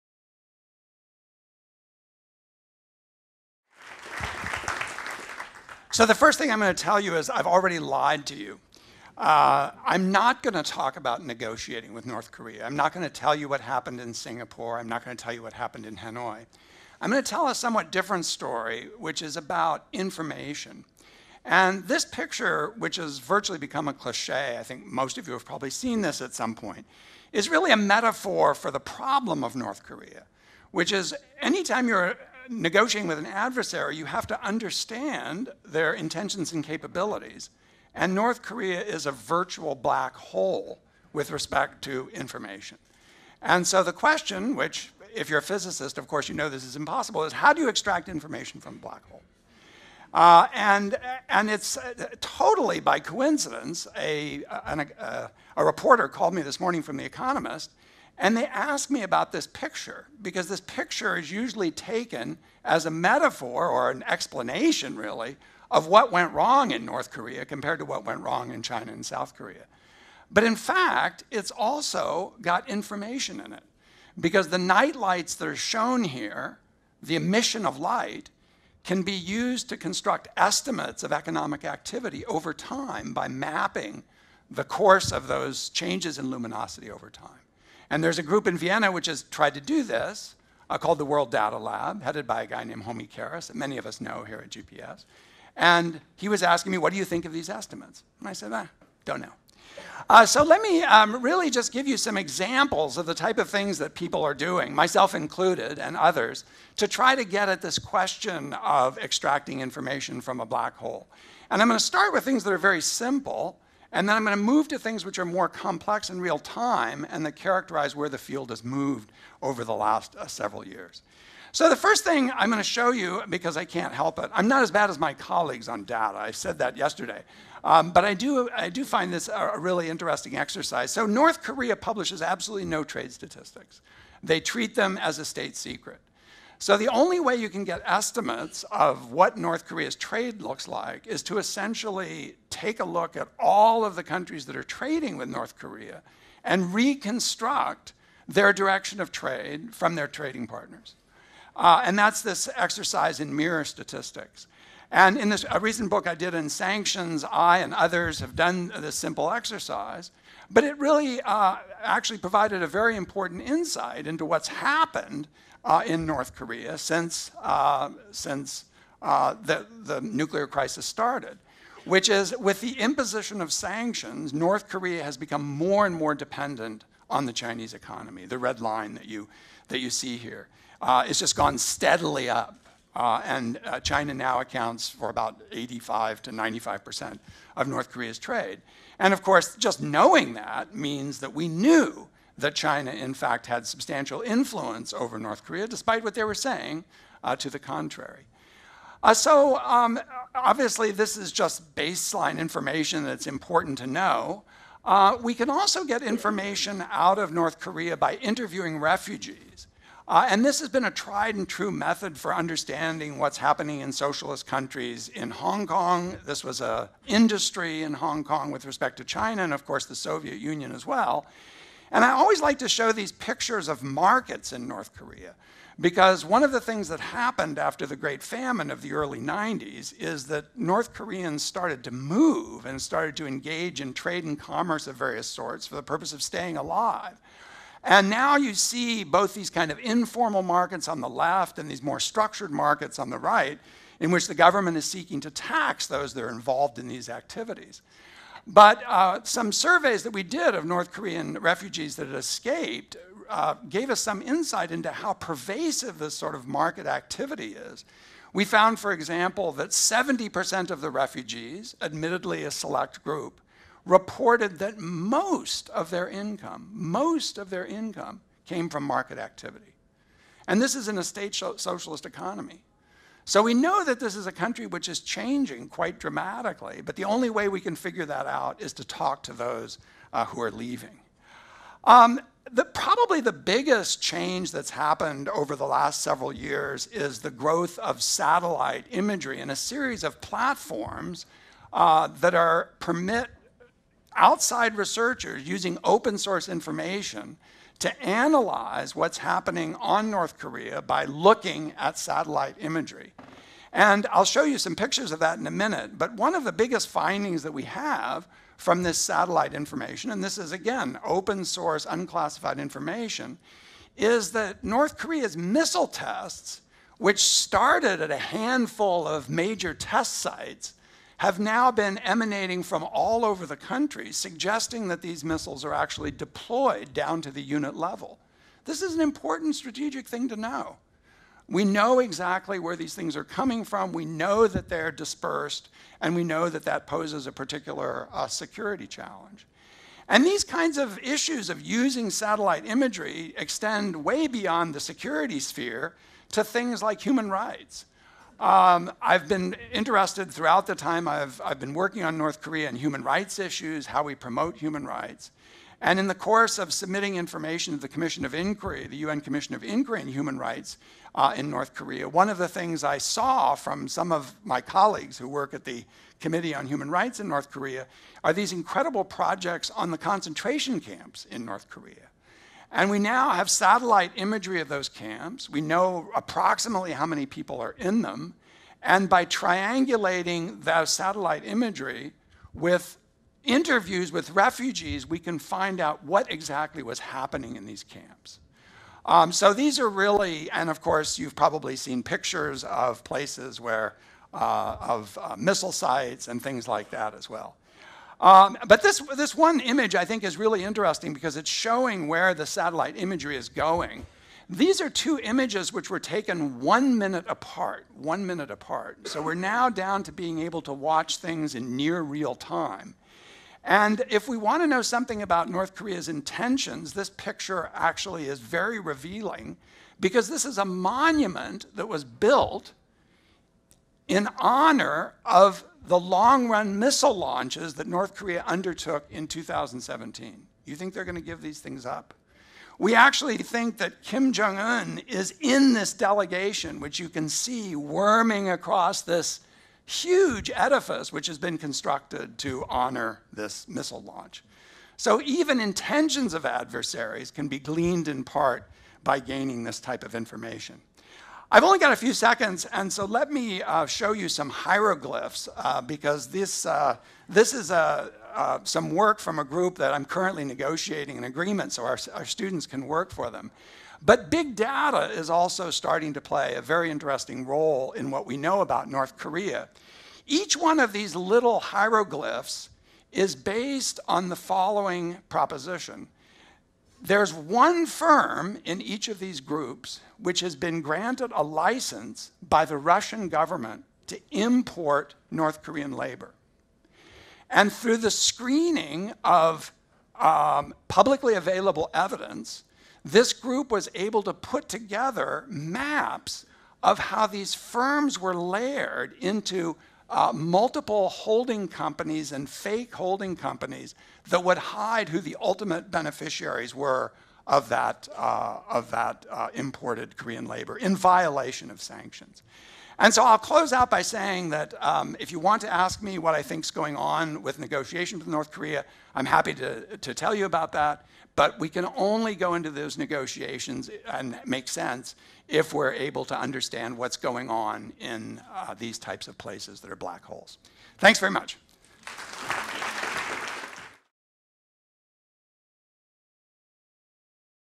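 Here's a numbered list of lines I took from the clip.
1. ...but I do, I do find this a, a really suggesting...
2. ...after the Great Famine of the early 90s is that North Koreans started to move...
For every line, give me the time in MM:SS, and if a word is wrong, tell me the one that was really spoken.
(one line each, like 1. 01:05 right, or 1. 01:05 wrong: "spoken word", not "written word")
1. 02:07 wrong: "interesting", not "suggesting"
2. 03:47 right.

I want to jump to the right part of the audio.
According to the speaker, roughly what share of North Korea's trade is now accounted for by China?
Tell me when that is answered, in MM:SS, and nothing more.
03:05.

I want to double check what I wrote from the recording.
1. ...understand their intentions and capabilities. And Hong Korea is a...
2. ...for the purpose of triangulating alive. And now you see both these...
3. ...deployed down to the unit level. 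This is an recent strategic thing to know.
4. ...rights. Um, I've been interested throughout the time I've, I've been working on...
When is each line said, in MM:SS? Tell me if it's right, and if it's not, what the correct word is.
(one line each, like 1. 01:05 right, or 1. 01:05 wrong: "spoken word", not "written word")
1. 00:34 wrong: "North", not "Hong"
2. 03:55 wrong: "staying", not "triangulating"
3. 05:26 wrong: "important", not "recent"
4. 05:47 right.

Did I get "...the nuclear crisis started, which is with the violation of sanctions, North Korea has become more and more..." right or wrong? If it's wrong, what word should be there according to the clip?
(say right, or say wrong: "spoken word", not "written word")
wrong: "imposition", not "violation".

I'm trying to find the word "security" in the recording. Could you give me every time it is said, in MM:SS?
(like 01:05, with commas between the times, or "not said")
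05:38, 05:44.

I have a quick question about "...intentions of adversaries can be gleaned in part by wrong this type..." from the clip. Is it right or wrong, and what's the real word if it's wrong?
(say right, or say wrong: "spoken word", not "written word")
wrong: "gaining", not "wrong".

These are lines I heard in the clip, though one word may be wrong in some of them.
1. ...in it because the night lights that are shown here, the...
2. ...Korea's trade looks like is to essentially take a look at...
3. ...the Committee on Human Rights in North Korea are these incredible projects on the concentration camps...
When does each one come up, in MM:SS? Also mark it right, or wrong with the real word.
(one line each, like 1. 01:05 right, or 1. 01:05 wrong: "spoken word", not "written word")
1. 01:13 right
2. 02:19 right
3. 06:05 right.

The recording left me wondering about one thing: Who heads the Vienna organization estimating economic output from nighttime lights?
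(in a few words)
Homi Kharas.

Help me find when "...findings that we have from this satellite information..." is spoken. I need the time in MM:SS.
05:06.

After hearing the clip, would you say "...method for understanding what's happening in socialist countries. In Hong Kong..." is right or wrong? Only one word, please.
right.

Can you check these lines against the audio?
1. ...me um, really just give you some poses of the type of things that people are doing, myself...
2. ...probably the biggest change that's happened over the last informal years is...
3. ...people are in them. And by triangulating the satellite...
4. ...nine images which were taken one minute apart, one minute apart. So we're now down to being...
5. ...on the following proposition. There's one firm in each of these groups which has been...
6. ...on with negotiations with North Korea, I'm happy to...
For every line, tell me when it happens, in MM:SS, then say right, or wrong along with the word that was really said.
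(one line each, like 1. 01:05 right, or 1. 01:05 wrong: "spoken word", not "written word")
1. 01:40 wrong: "examples", not "poses"
2. 04:42 wrong: "several", not "informal"
3. 06:17 right
4. 06:44 wrong: "two", not "nine"
5. 07:54 right
6. 08:36 right.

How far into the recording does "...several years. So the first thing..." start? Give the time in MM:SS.
02:00.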